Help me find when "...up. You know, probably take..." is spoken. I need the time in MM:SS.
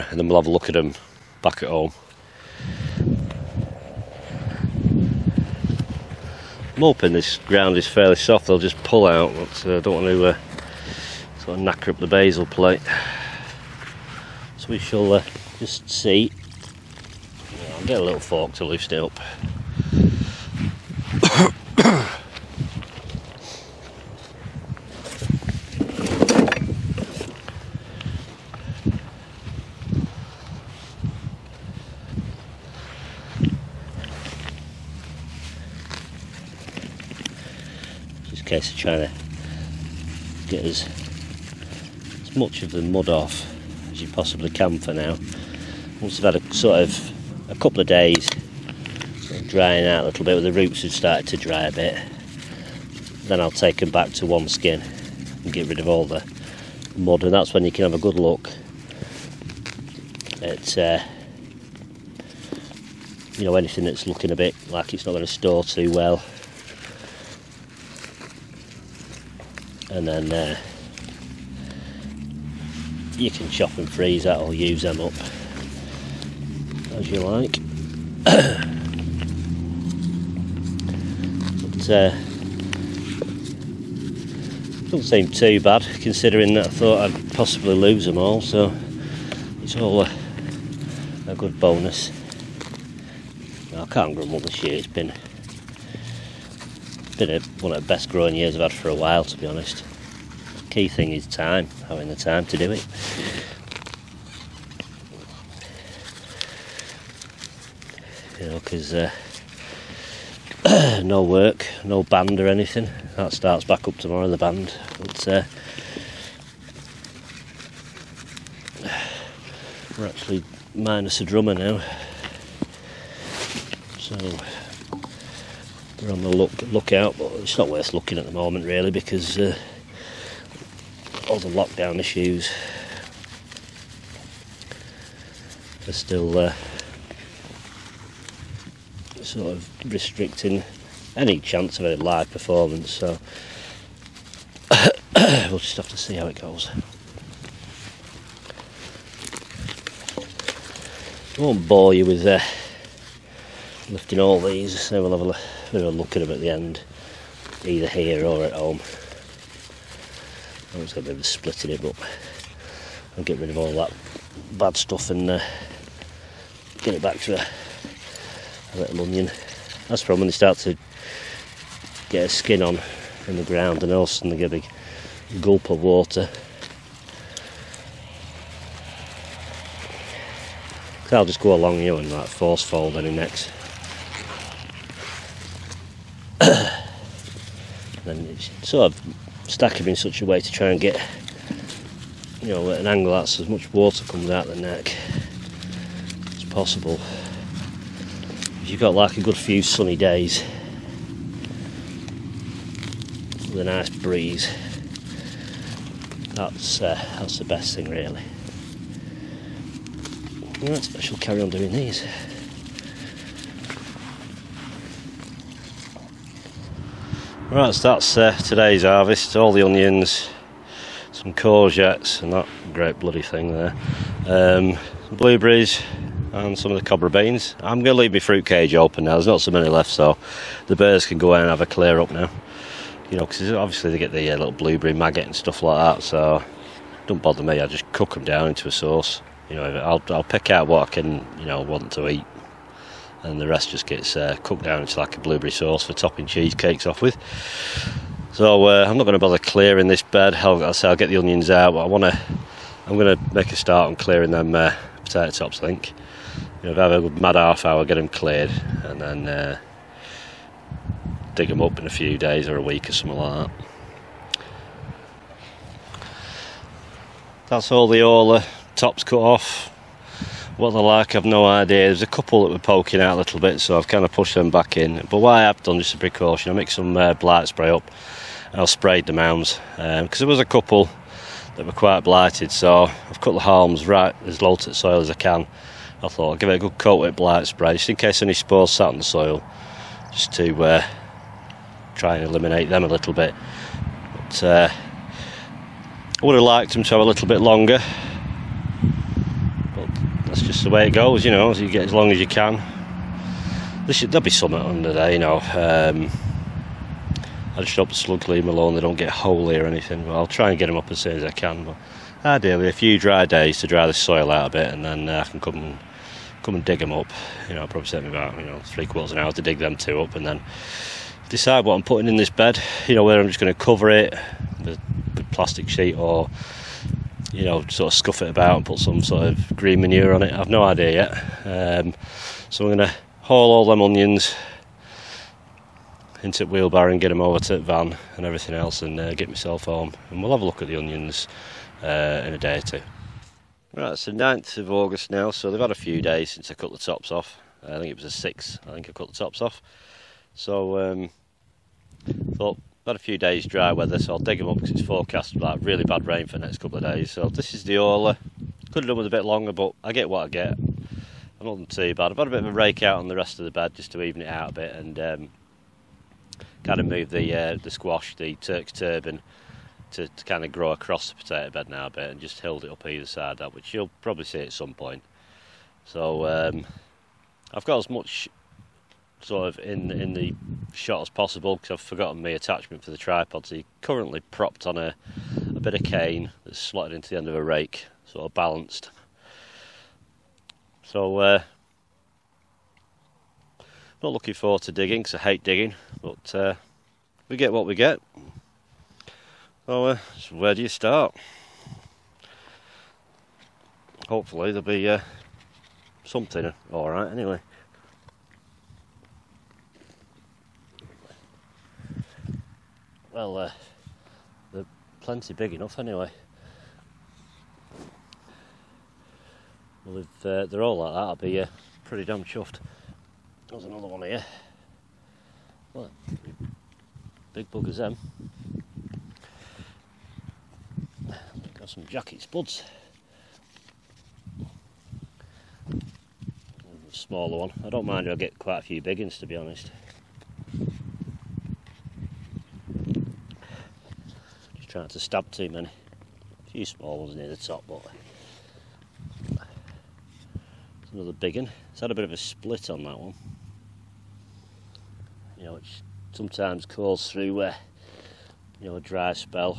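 05:16.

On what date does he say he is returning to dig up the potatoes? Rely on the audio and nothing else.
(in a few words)
9 August.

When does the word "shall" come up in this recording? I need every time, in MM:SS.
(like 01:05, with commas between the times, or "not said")
00:14, 03:30.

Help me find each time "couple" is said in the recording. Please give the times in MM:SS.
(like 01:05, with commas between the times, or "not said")
00:47, 04:32, 04:40, 05:56.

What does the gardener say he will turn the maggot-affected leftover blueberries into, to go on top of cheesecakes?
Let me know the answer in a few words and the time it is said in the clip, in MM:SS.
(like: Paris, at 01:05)
blueberry sauce, at 04:05.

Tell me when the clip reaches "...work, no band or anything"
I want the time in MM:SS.
01:51.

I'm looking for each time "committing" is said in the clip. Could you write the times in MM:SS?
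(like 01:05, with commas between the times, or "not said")
not said.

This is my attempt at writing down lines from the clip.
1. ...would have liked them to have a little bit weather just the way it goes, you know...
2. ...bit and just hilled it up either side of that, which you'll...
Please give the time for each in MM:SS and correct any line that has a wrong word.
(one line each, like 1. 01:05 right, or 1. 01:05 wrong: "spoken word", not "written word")
1. 04:56 wrong: "longer", not "weather"
2. 06:11 right.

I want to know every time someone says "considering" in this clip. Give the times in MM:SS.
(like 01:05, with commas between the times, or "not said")
01:26.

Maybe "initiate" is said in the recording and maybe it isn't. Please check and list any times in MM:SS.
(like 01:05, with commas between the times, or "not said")
not said.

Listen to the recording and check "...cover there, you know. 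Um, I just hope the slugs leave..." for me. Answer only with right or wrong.
wrong.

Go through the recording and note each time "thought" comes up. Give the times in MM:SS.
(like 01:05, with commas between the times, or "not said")
01:26, 04:46, 05:52.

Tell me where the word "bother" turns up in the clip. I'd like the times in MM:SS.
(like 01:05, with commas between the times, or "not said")
03:57, 04:09.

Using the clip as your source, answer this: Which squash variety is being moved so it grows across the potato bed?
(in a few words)
Turk's turban.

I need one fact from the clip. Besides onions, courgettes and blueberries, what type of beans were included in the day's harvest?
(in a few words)
cobra beans.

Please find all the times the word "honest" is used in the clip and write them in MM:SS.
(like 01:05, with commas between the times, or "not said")
01:39, 07:19.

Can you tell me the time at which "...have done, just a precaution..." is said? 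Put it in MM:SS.
04:35.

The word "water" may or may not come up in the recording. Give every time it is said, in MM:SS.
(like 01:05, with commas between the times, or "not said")
02:55, 03:13.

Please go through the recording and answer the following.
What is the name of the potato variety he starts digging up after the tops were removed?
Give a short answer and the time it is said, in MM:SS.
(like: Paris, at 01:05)
Orla, at 05:57.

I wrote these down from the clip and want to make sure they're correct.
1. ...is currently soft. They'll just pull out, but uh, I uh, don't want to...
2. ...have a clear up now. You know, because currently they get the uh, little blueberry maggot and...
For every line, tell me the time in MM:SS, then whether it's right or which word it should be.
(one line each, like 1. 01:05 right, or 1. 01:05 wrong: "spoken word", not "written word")
1. 00:07 wrong: "fairly", not "currently"
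2. 03:51 wrong: "obviously", not "currently".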